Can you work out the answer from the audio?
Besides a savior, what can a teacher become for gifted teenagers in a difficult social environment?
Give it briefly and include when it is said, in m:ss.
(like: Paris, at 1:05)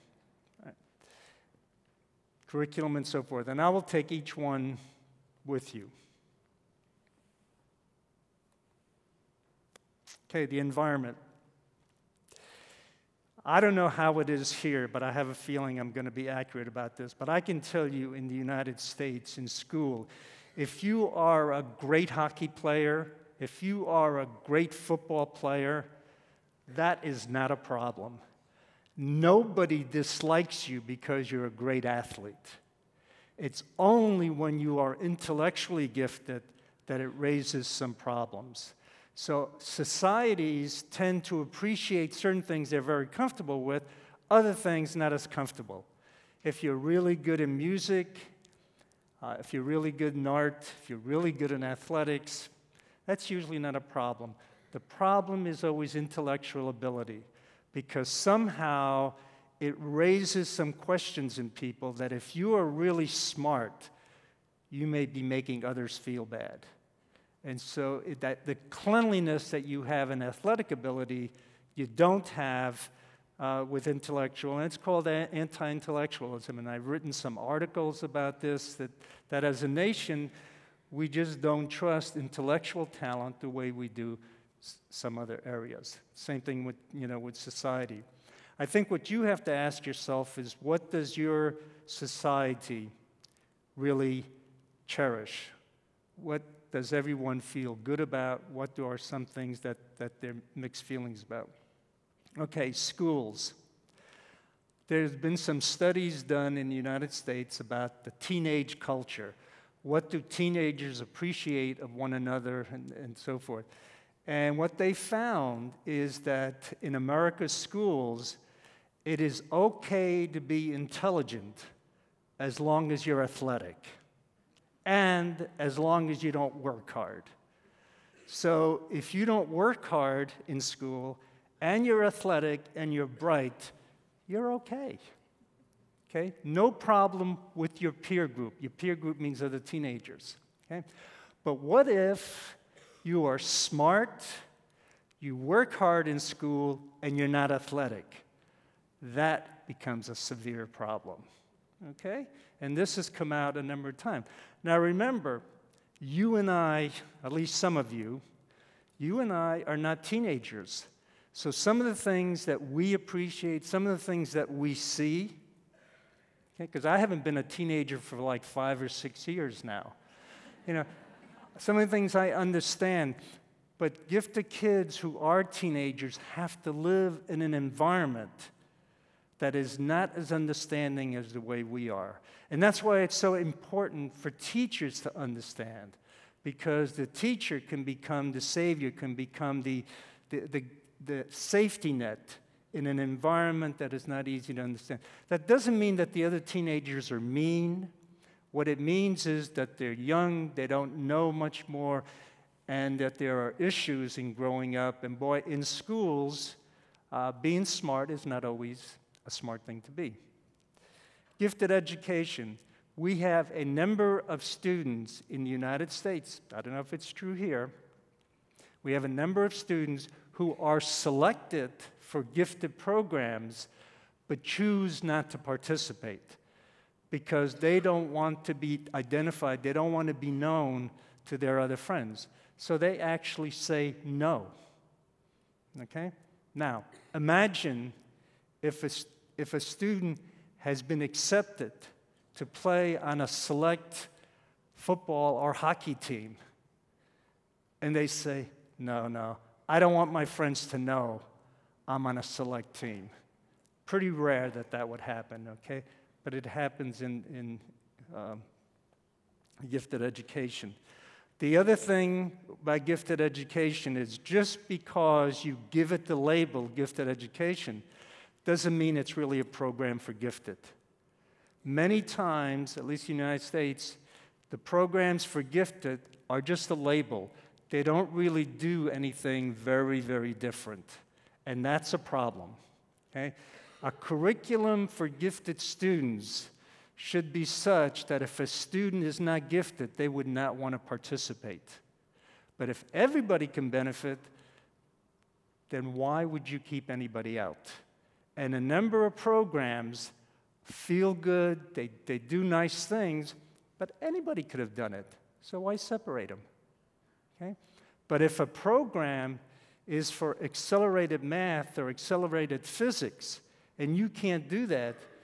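safety net, at 3:11.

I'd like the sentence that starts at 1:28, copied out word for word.
I think what you have to ask yourself is what does your society really cherish?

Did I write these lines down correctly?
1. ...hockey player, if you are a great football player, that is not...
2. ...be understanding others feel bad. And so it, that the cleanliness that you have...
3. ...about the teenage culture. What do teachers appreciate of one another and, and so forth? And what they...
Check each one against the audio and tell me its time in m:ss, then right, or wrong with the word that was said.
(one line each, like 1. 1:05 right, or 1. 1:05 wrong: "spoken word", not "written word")
1. 0:22 right
2. 1:05 wrong: "making", not "understanding"
3. 1:47 wrong: "teenagers", not "teachers".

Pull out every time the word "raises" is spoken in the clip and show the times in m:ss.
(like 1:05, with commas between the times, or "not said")
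0:37, 0:59.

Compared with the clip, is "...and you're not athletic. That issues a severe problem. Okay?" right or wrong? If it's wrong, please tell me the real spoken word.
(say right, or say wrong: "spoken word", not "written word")
wrong: "becomes", not "issues".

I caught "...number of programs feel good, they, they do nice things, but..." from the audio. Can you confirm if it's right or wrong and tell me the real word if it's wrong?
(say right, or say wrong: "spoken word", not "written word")
right.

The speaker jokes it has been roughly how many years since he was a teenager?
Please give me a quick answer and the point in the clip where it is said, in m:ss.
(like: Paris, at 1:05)
5 or 6 years, at 2:48.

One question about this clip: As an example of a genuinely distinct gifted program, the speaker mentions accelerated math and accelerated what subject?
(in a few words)
physics.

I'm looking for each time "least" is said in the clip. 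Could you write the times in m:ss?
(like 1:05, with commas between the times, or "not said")
2:37, 4:32.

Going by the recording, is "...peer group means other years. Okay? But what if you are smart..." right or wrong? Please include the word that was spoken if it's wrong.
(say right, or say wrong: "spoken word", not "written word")
wrong: "teenagers", not "years".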